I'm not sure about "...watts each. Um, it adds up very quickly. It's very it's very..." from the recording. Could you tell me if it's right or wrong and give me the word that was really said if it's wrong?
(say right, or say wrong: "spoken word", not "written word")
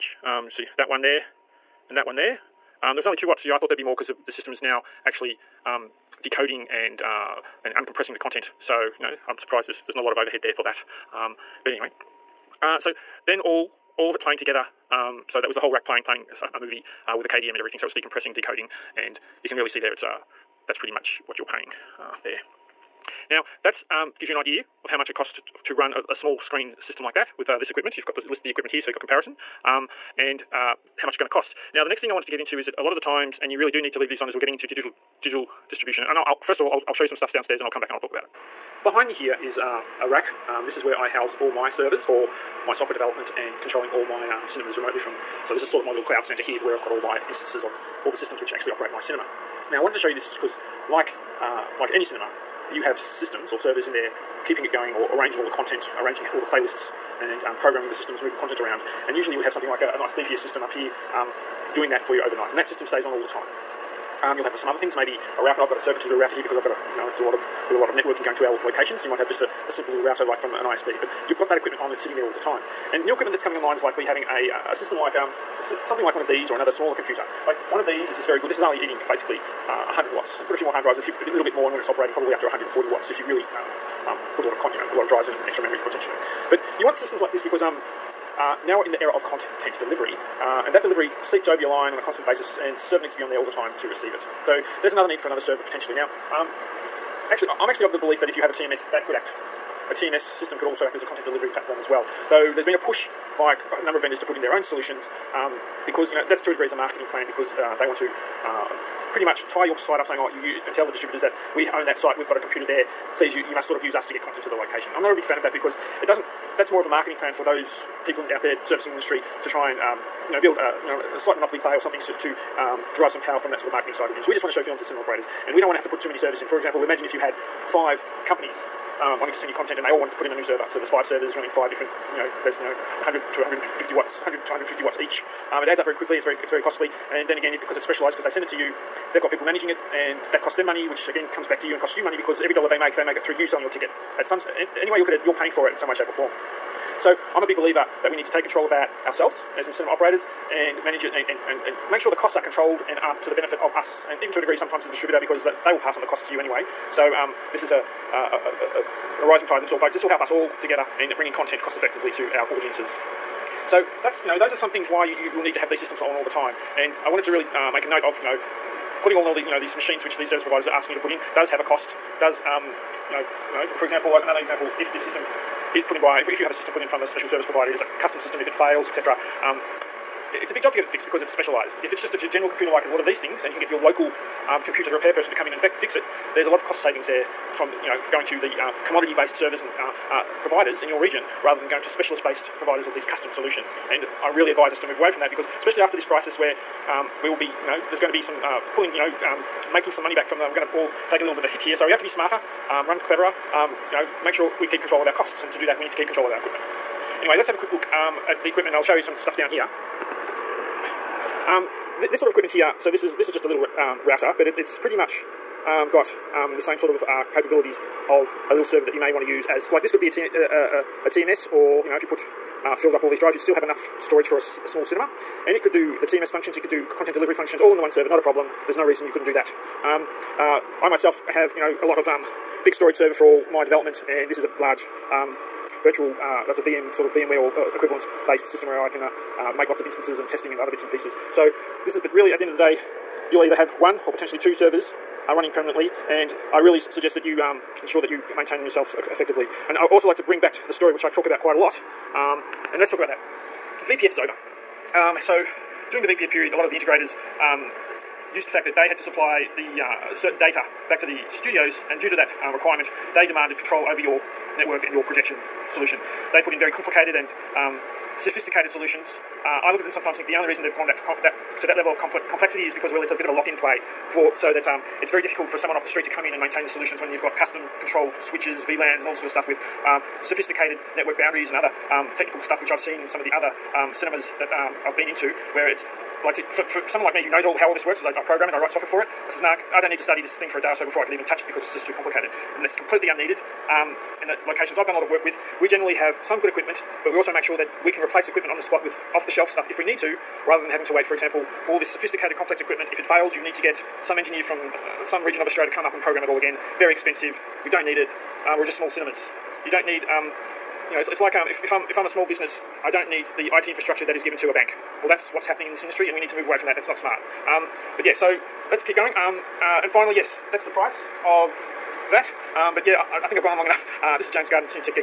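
right.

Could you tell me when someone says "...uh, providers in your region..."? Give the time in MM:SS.
03:10.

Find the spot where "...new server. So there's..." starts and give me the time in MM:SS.
02:10.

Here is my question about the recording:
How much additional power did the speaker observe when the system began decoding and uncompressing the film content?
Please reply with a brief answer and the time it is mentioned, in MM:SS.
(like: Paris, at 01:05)
2 watts, at 00:03.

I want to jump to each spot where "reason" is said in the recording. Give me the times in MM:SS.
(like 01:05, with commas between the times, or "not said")
03:48, 04:30.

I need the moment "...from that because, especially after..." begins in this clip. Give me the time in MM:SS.
03:15.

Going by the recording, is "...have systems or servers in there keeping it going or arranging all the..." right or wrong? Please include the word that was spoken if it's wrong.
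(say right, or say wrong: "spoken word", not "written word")
right.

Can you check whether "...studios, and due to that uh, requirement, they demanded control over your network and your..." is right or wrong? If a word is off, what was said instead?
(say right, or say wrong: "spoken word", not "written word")
right.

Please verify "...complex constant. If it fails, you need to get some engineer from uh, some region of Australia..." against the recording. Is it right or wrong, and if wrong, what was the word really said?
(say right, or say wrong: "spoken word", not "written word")
wrong: "equipment", not "constant".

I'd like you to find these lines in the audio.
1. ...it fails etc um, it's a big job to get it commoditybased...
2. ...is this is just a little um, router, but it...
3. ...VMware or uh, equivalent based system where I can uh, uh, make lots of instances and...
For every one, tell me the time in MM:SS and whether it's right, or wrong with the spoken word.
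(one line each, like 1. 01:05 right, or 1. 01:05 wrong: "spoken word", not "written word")
1. 02:58 wrong: "fixed", not "commoditybased"
2. 03:33 right
3. 03:57 right.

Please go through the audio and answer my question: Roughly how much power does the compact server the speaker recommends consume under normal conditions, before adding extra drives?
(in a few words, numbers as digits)
100 watts.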